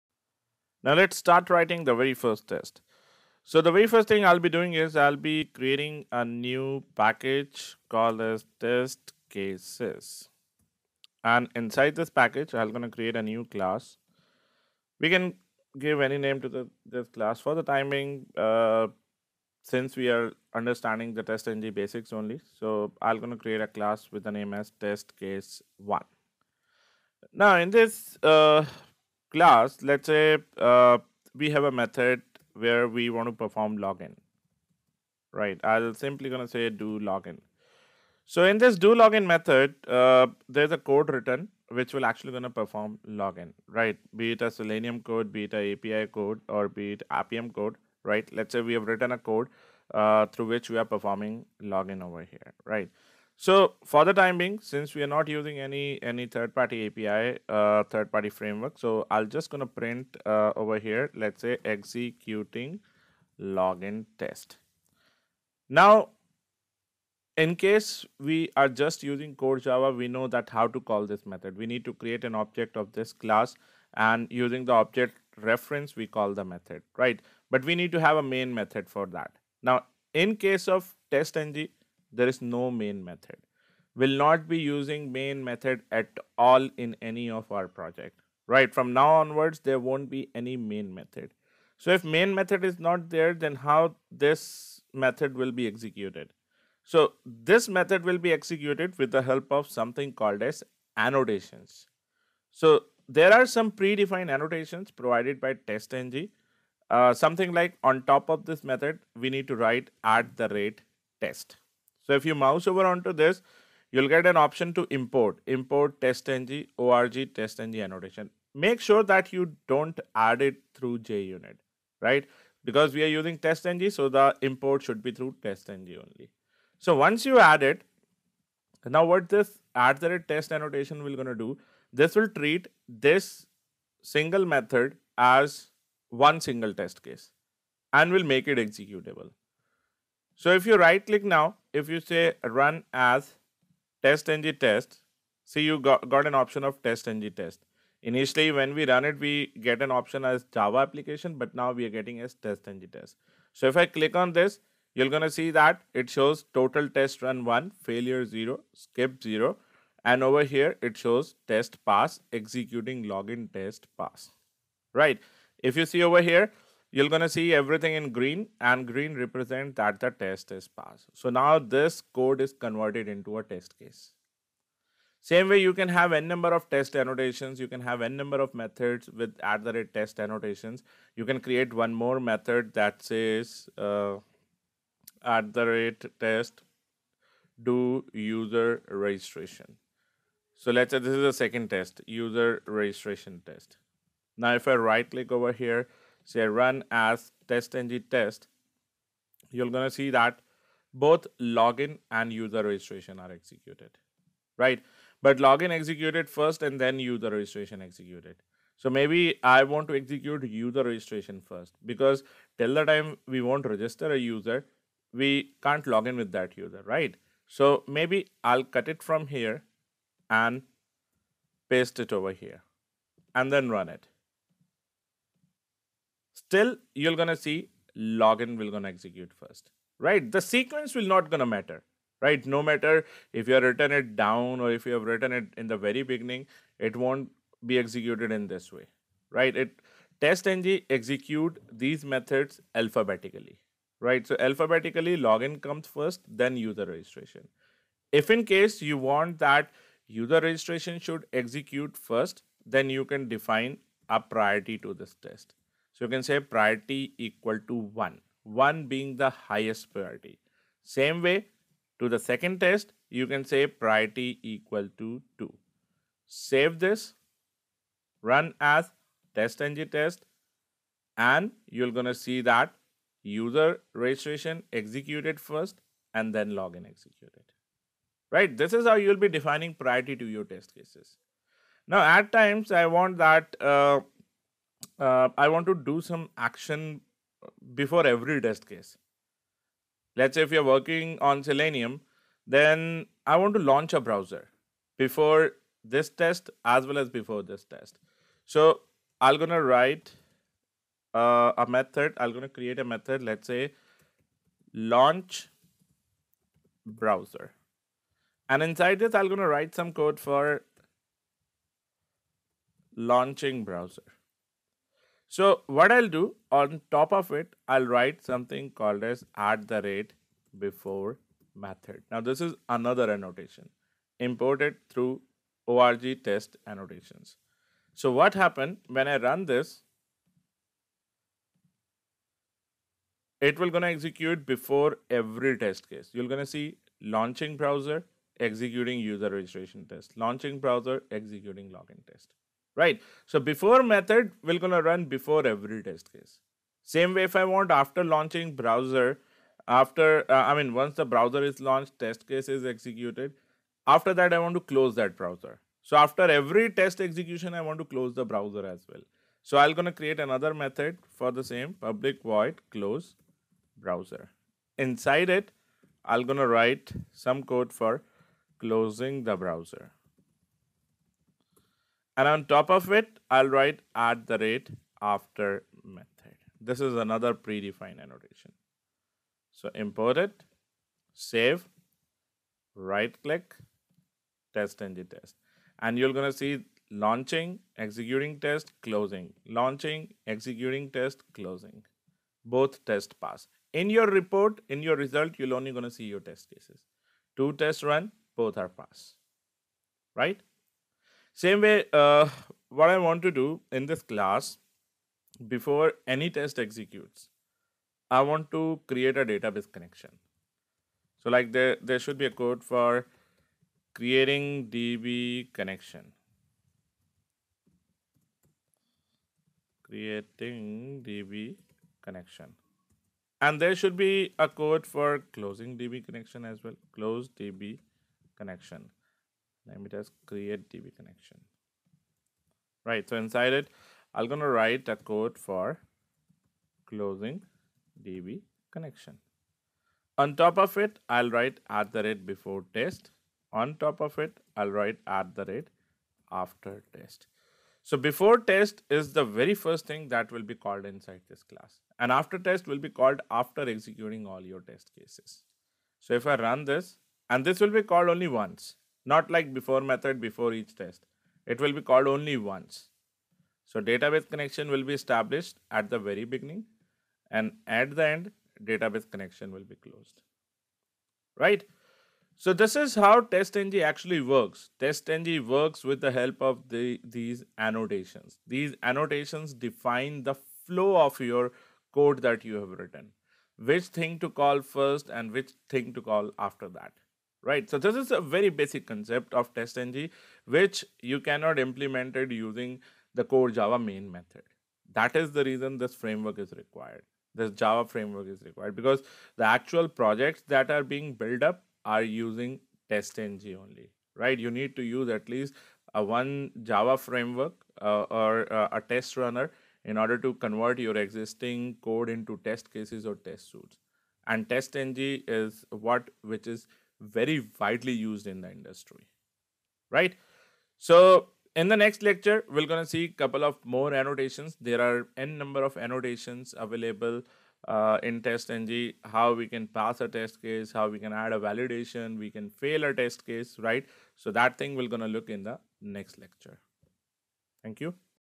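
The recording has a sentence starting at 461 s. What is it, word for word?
It will be called only once.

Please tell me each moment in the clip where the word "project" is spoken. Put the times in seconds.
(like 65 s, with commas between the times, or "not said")
87 s, 499 s.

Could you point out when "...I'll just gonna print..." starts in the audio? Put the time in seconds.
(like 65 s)
59 s.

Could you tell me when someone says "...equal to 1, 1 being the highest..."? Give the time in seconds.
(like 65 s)
257 s.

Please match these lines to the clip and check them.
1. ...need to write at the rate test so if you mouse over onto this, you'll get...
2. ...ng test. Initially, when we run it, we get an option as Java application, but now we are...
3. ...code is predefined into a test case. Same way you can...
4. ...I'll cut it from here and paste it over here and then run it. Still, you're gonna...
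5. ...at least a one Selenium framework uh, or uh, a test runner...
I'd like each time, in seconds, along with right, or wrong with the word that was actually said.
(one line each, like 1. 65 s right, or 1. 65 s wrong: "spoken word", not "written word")
1. 109 s right
2. 147 s right
3. 172 s wrong: "converted", not "predefined"
4. 218 s right
5. 505 s wrong: "Java", not "Selenium".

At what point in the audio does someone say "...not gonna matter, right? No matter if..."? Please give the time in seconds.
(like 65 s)
231 s.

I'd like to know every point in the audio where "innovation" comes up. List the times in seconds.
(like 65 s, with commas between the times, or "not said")
not said.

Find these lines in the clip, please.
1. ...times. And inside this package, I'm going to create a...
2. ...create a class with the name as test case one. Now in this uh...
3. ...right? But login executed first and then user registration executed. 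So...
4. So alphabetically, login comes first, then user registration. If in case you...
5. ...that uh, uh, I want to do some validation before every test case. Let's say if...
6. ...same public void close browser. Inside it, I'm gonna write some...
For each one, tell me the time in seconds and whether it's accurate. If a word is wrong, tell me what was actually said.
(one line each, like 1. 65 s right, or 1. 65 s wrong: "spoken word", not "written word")
1. 9 s wrong: "cases", not "times"
2. 23 s right
3. 204 s right
4. 244 s right
5. 283 s wrong: "action", not "validation"
6. 361 s right.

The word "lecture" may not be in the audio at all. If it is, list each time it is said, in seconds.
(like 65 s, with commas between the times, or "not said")
522 s, 536 s.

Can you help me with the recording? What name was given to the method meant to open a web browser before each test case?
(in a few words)
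launch browser.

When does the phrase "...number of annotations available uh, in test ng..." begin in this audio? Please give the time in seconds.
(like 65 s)
525 s.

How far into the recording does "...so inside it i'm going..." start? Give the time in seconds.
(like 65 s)
433 s.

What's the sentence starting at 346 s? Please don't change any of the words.
Same way if I want after launching browser, after, uh, I mean, once the browser is launched, test case is executed.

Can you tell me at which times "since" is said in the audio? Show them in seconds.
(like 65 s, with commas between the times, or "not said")
19 s, 54 s.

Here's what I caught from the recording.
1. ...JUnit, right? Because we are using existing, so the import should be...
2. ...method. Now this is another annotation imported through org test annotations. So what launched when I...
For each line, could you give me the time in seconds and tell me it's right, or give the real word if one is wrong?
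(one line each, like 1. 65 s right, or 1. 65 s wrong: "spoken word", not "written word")
1. 120 s wrong: "testng", not "existing"
2. 321 s wrong: "happened", not "launched".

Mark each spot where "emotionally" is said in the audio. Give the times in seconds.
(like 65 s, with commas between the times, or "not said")
not said.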